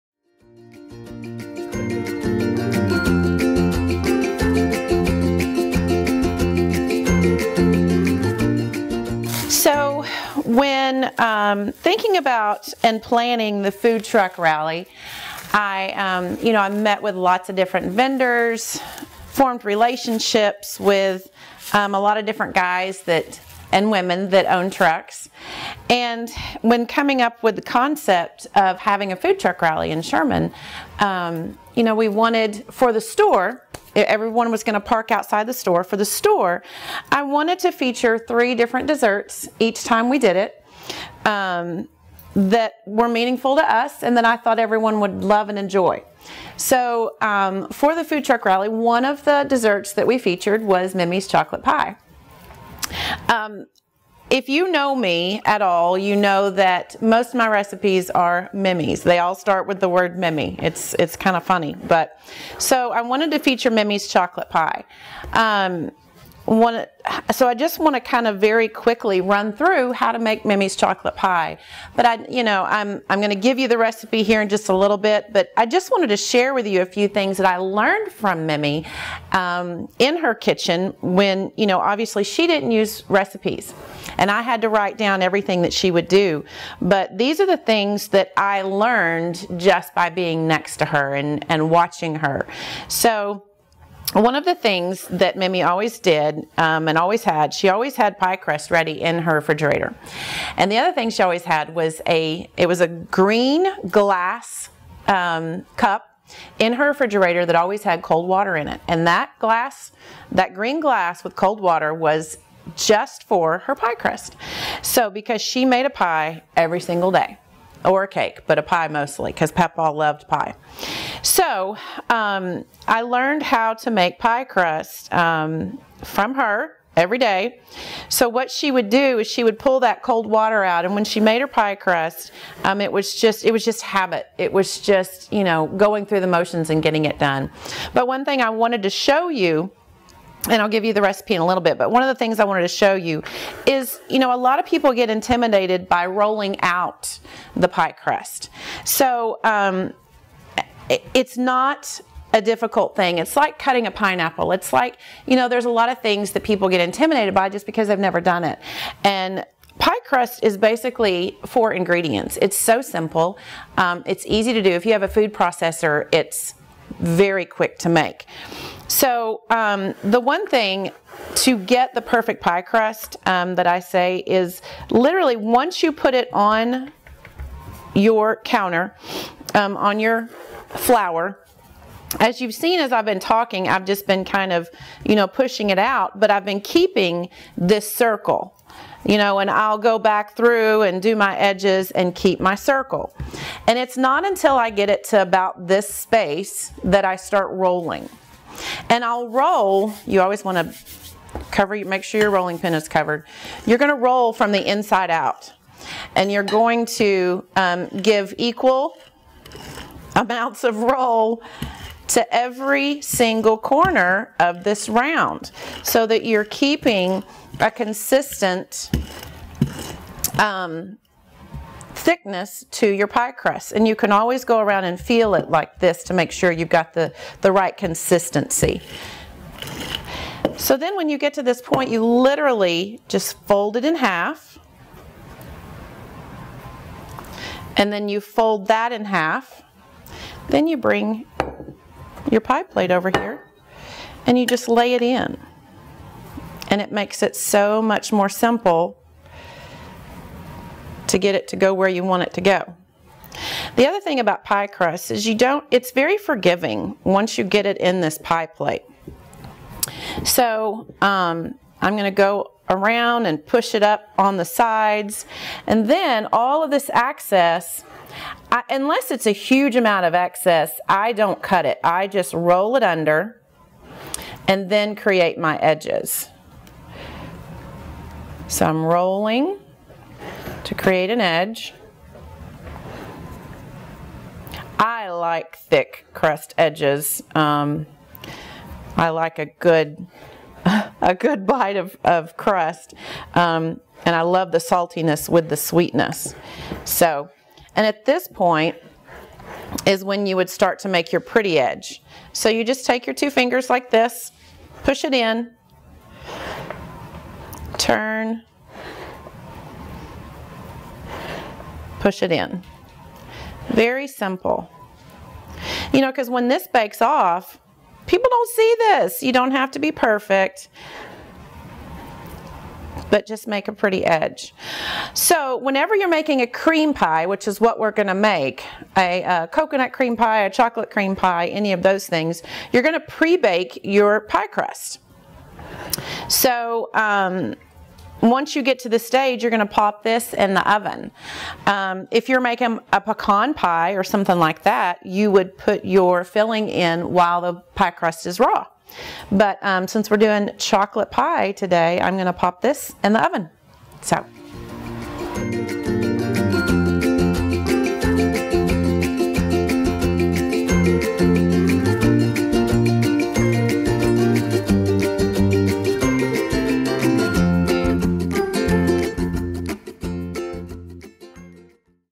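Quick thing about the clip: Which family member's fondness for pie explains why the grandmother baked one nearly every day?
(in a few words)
Papa.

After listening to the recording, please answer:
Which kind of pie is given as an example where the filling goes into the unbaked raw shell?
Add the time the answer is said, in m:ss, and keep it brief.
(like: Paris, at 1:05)
Pecan pie, at 5:43.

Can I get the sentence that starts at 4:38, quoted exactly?
So I'm rolling to create an edge.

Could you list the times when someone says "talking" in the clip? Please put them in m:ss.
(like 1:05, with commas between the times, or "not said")
3:03.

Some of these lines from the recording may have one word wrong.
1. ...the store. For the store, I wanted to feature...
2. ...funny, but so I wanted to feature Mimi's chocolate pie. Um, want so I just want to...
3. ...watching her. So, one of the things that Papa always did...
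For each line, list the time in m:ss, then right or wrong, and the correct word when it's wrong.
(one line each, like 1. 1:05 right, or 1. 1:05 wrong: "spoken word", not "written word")
1. 0:35 right
2. 1:01 right
3. 1:31 wrong: "Mimi", not "Papa".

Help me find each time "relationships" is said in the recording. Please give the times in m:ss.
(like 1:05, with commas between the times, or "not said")
0:19.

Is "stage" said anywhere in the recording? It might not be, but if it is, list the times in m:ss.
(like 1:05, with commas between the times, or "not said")
5:38.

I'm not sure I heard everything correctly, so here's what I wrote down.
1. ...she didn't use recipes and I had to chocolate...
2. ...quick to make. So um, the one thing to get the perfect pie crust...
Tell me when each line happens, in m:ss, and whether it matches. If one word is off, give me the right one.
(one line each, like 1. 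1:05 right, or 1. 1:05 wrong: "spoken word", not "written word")
1. 1:22 wrong: "write", not "chocolate"
2. 2:47 right.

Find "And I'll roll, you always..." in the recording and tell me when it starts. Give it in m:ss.
3:18.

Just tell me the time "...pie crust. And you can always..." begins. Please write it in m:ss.
3:43.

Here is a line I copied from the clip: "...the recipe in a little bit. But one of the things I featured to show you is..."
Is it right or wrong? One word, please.
wrong.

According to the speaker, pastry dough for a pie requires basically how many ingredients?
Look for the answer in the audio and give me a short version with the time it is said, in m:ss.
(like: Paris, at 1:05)
4, at 2:41.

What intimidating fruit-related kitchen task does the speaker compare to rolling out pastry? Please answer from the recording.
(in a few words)
Cutting a pineapple.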